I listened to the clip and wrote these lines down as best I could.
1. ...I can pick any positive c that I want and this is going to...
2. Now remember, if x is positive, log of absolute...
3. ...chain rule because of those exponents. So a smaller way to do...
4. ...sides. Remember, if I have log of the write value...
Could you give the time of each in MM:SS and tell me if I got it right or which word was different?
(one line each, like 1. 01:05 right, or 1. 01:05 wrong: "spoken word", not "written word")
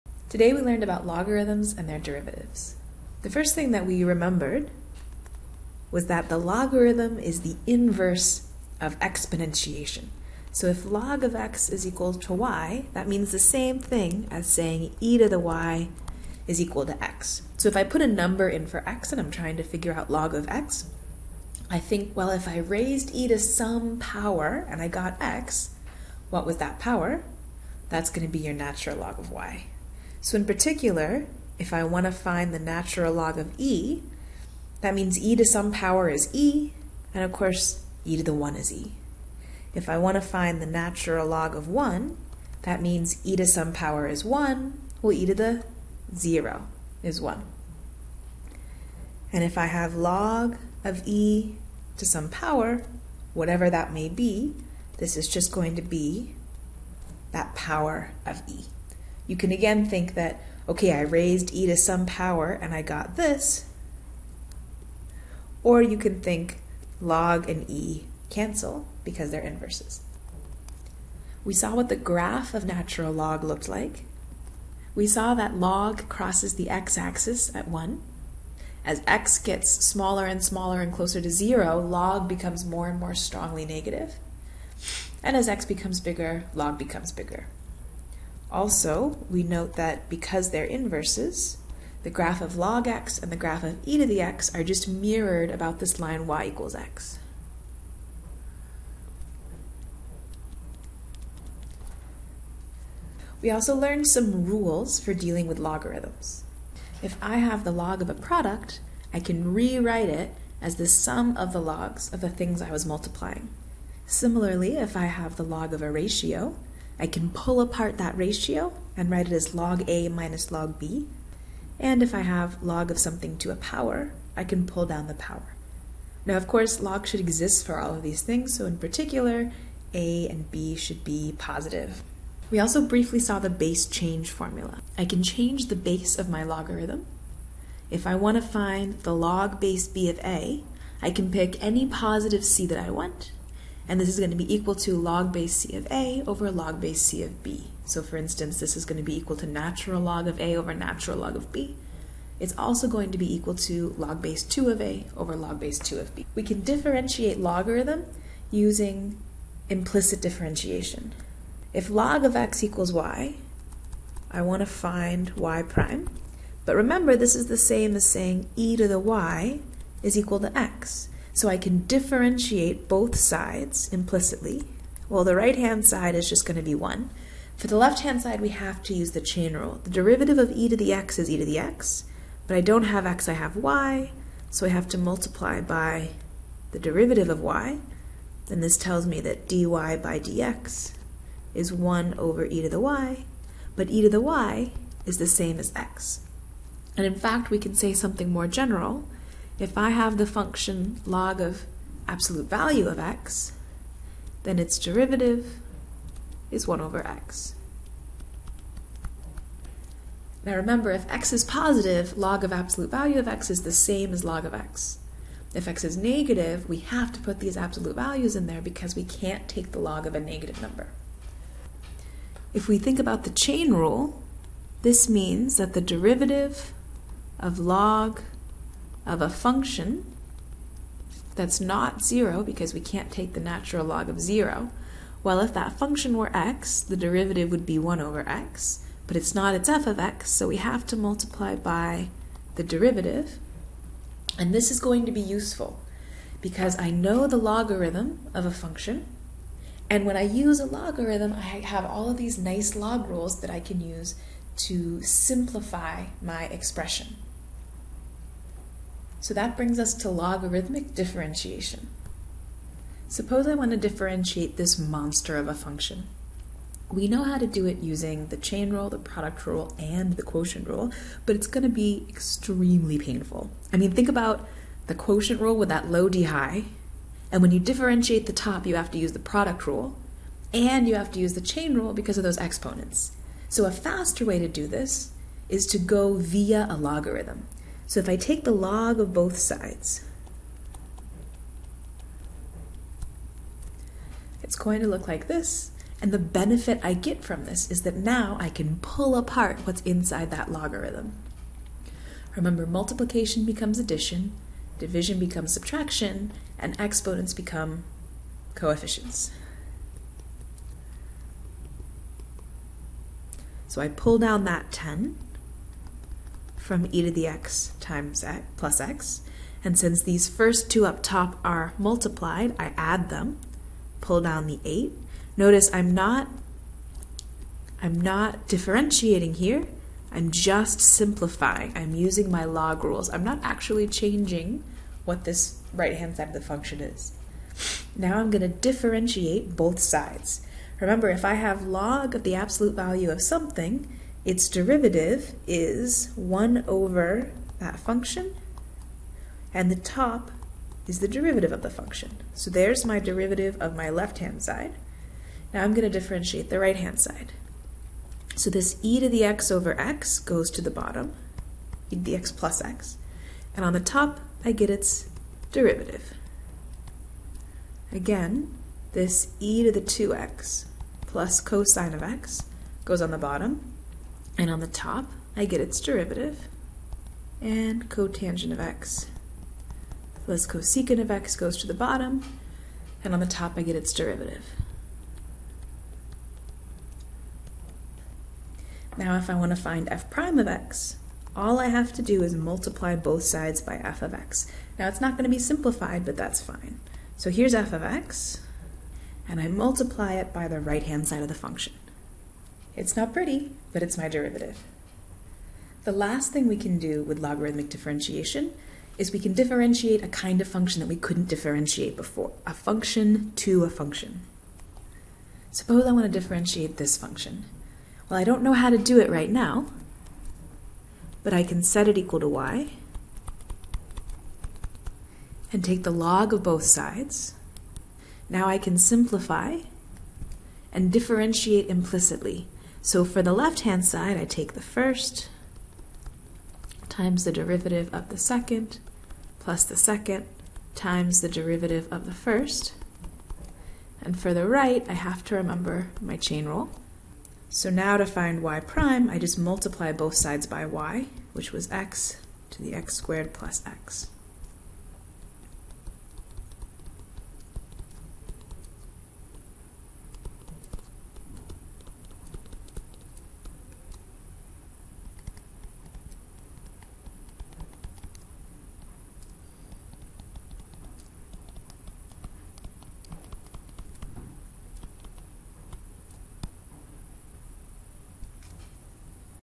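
1. 02:21 right
2. 03:30 right
3. 04:41 wrong: "faster", not "smaller"
4. 05:39 wrong: "absolute", not "write".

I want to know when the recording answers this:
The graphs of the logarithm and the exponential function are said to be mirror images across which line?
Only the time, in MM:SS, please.
01:36.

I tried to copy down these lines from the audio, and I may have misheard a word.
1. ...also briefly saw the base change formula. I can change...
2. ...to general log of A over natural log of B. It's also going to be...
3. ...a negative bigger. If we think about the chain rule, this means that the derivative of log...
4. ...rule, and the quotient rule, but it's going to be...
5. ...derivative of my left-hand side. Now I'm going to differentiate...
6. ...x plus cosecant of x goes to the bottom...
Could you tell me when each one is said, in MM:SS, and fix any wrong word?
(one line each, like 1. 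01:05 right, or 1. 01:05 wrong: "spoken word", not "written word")
1. 02:12 right
2. 02:29 wrong: "natural", not "general"
3. 03:40 wrong: "number", not "bigger"
4. 04:29 right
5. 05:52 right
6. 06:18 right.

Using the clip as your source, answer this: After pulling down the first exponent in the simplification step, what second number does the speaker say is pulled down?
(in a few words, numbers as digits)
8.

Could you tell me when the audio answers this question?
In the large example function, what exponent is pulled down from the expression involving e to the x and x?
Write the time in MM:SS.
05:14.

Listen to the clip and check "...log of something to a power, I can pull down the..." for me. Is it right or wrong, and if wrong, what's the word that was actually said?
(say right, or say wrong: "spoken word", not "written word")
right.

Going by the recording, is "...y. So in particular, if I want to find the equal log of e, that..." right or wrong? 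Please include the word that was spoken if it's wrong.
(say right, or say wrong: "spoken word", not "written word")
wrong: "natural", not "equal".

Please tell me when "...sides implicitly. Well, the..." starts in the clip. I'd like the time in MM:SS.
02:53.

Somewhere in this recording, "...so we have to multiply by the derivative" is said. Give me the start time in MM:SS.
04:00.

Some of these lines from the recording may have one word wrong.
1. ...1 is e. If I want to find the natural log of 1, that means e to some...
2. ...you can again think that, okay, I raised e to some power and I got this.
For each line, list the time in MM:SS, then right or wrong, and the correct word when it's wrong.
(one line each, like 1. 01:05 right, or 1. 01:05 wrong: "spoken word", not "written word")
1. 00:38 right
2. 00:59 right.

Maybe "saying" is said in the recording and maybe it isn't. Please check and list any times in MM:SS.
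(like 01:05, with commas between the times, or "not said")
00:14, 02:48.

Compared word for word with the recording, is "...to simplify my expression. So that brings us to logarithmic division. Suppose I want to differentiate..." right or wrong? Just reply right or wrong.
wrong.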